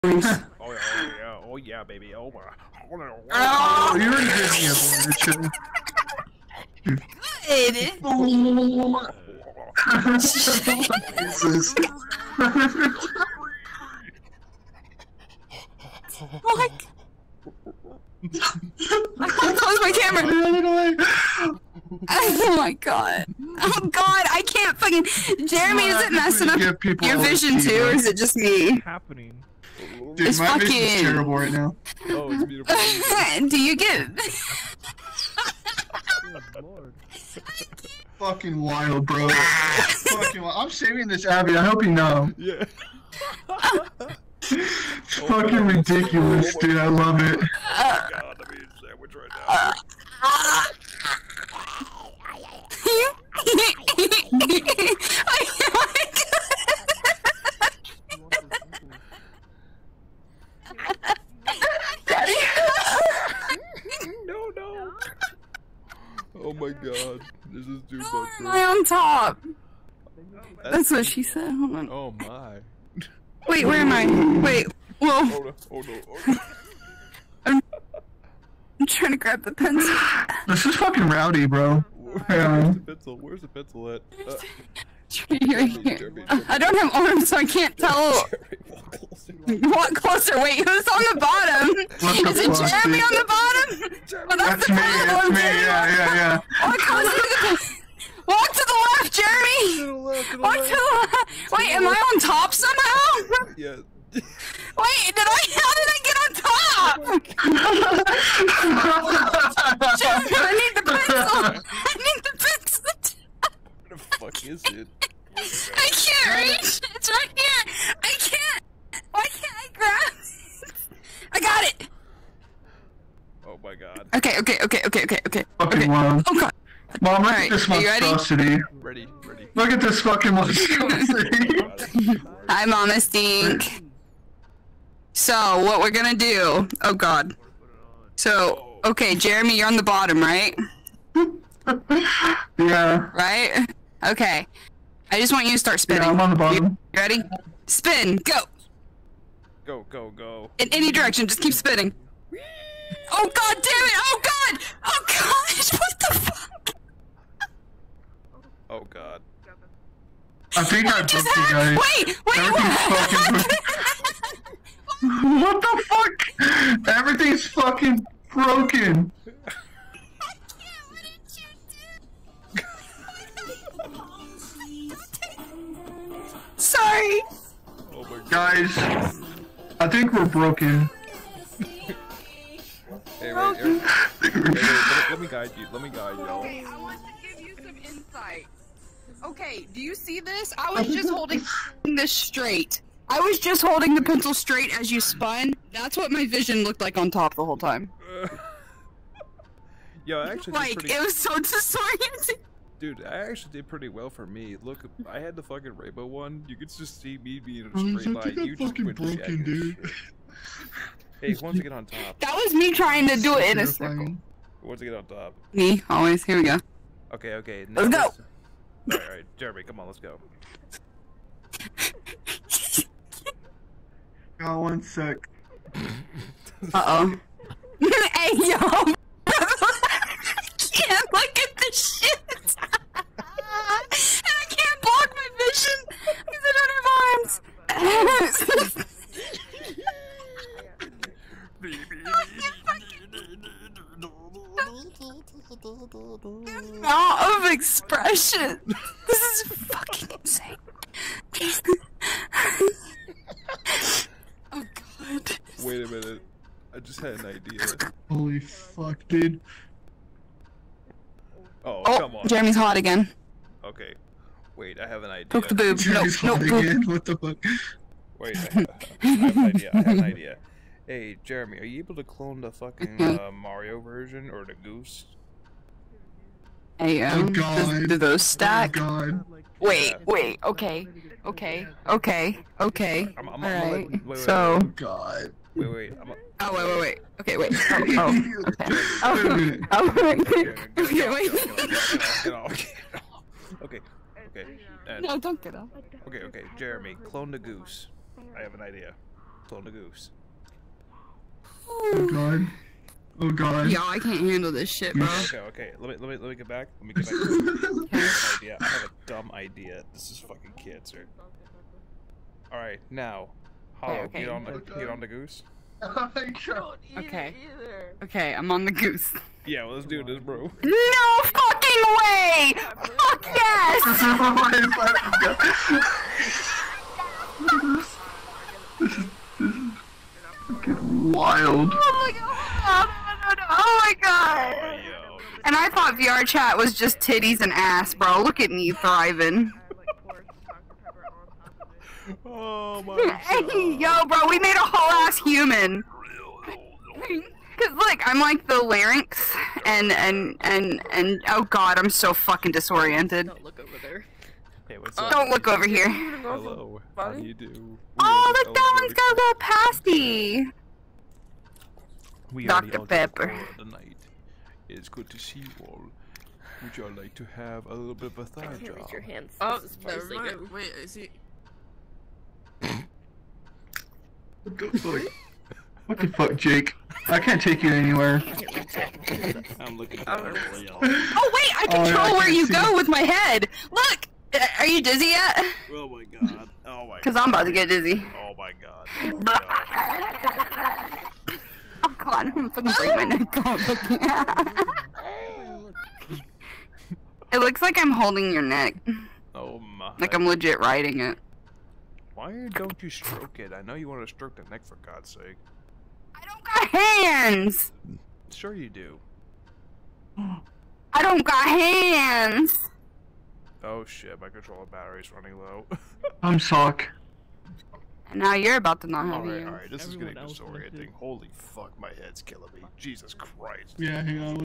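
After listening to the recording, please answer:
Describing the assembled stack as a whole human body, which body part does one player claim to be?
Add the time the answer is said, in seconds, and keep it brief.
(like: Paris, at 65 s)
the larynx, at 348 s.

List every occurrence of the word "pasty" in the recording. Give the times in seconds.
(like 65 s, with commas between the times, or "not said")
359 s.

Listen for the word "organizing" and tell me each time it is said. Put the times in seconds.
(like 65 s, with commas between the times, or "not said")
not said.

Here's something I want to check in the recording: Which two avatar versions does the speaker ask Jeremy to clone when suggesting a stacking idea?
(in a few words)
Mario version or the goose.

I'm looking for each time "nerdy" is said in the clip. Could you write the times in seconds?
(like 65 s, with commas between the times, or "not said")
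not said.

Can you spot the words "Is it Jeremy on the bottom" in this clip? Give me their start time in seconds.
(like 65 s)
92 s.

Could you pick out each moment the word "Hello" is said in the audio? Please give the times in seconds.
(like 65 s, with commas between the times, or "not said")
355 s.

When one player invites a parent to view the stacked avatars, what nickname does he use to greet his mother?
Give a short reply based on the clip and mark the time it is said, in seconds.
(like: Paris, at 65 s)
Mama Stink, at 132 s.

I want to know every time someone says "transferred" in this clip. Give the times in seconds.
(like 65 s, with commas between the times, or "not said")
not said.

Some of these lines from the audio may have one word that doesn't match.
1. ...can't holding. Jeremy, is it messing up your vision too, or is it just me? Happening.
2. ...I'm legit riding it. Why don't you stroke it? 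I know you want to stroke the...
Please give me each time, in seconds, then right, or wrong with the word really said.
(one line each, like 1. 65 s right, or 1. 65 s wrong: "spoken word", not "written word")
1. 24 s wrong: "fucking", not "holding"
2. 400 s right.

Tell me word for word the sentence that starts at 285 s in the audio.
Wait, wait, i Oh, wait, wait, wait.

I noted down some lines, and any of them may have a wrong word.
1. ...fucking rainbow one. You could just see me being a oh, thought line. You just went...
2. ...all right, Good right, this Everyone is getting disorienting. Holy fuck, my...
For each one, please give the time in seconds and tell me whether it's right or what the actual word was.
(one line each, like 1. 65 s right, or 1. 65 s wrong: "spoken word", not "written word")
1. 205 s wrong: "straight", not "thought"
2. 419 s wrong: "All", not "Good".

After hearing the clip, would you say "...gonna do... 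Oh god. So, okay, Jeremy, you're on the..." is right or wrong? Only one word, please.
right.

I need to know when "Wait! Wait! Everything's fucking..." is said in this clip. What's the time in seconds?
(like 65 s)
162 s.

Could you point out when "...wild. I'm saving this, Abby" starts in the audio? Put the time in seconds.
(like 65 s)
40 s.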